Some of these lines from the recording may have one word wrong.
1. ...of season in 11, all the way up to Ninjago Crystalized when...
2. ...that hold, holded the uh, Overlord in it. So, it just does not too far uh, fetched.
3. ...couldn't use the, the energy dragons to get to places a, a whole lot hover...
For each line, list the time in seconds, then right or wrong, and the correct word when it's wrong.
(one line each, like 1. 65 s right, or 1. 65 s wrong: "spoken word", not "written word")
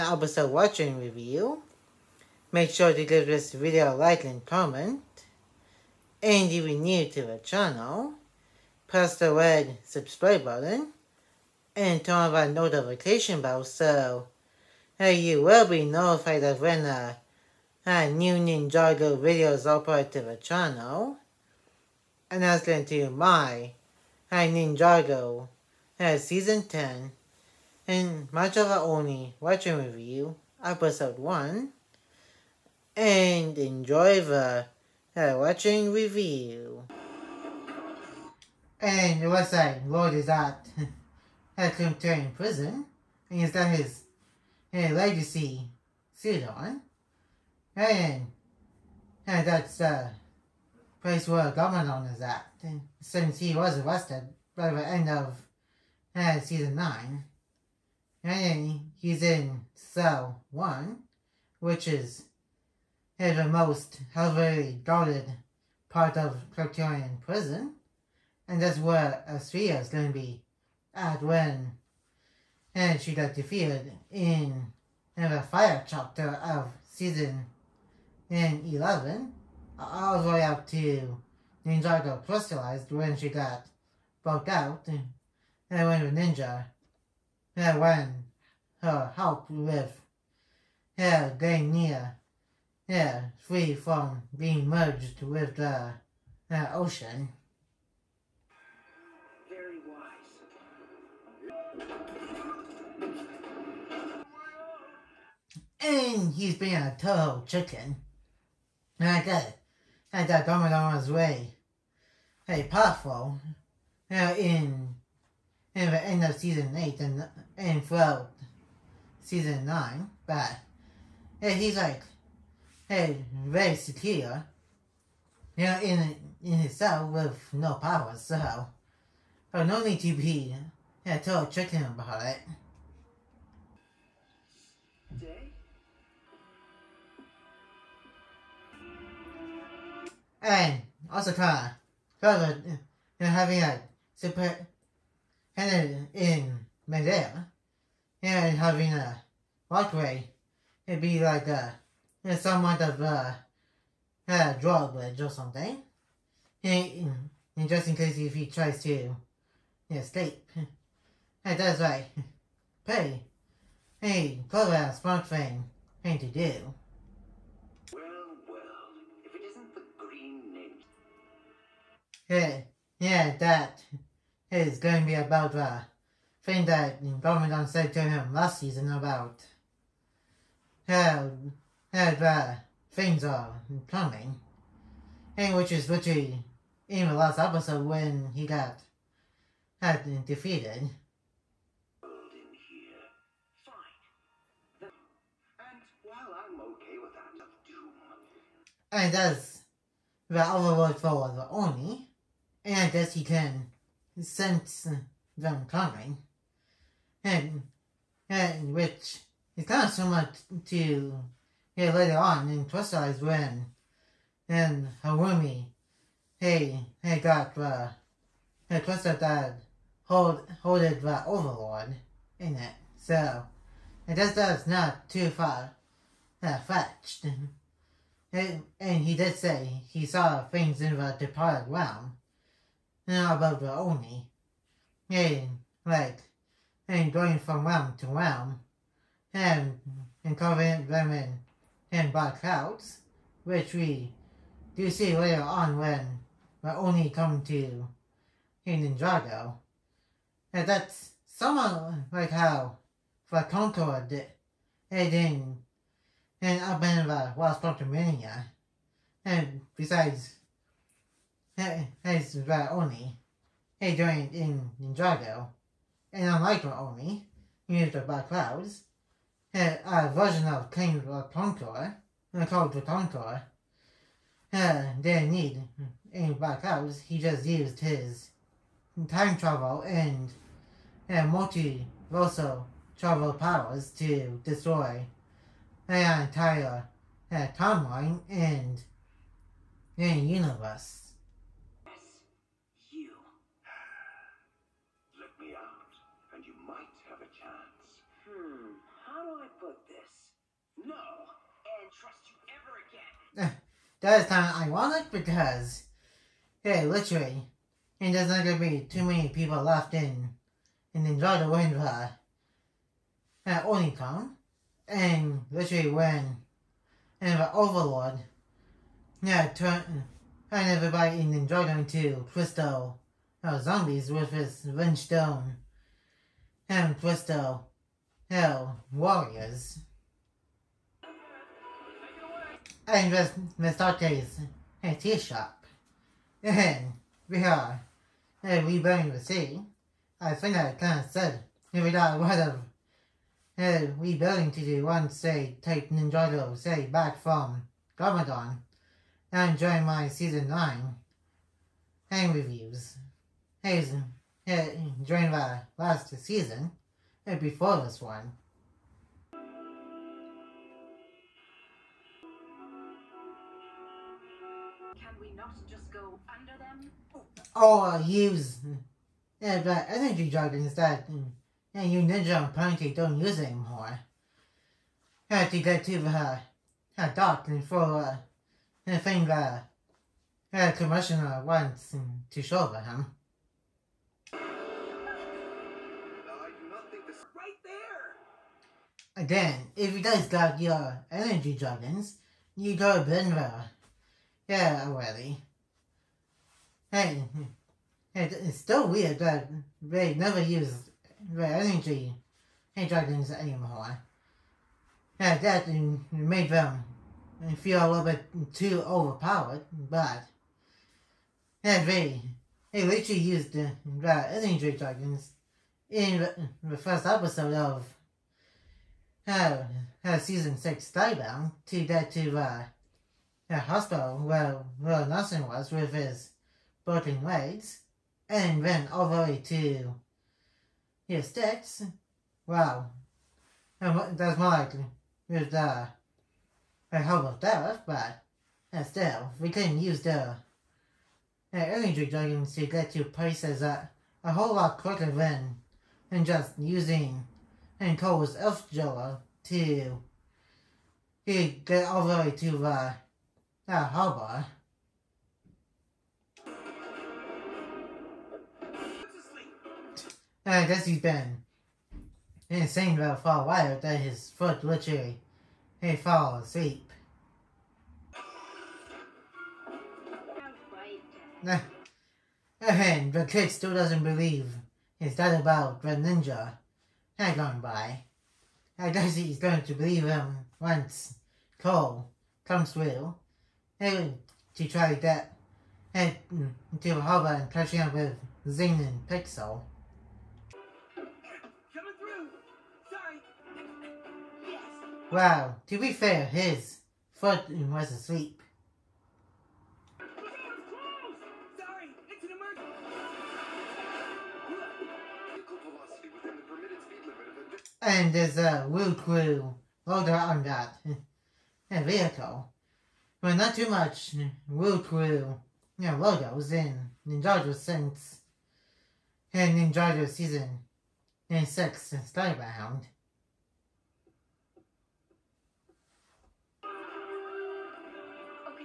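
1. 76 s right
2. 219 s right
3. 439 s wrong: "quicker", not "hover".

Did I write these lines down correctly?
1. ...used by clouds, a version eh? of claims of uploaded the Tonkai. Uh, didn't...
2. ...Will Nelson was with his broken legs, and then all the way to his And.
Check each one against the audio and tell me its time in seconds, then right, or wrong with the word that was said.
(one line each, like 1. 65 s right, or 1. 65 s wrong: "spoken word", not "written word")
1. 267 s wrong: "called", not "uploaded"
2. 424 s wrong: "Stiix", not "And".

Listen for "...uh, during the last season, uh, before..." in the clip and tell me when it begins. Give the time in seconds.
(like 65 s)
353 s.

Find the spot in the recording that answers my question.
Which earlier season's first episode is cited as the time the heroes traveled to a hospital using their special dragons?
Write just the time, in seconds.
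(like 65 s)
420 s.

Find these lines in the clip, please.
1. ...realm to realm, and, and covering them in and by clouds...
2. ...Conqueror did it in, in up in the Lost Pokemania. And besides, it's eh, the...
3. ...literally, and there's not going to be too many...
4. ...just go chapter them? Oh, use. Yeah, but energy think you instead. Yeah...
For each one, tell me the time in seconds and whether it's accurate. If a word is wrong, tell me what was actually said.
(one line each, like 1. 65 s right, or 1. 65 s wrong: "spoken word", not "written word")
1. 237 s right
2. 253 s right
3. 306 s right
4. 365 s wrong: "under", not "chapter".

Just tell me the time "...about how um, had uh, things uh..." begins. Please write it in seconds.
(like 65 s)
178 s.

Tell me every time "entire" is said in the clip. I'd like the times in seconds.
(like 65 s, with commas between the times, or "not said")
286 s.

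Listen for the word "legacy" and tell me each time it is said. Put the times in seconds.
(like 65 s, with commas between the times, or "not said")
44 s.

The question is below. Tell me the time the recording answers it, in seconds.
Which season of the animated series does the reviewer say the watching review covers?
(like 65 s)
26 s.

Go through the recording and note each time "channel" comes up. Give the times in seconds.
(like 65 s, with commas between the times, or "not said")
7 s, 20 s.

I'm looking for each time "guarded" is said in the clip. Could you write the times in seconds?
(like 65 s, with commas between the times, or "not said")
64 s.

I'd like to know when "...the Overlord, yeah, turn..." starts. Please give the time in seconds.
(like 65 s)
317 s.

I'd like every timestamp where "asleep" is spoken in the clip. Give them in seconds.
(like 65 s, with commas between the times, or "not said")
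466 s, 497 s.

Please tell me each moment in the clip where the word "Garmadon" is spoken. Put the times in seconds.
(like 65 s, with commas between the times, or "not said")
51 s, 177 s, 347 s.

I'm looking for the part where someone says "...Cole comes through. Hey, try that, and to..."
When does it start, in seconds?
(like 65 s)
481 s.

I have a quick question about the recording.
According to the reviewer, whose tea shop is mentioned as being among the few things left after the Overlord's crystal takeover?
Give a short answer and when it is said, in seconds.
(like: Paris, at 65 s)
Miss Arte, at 333 s.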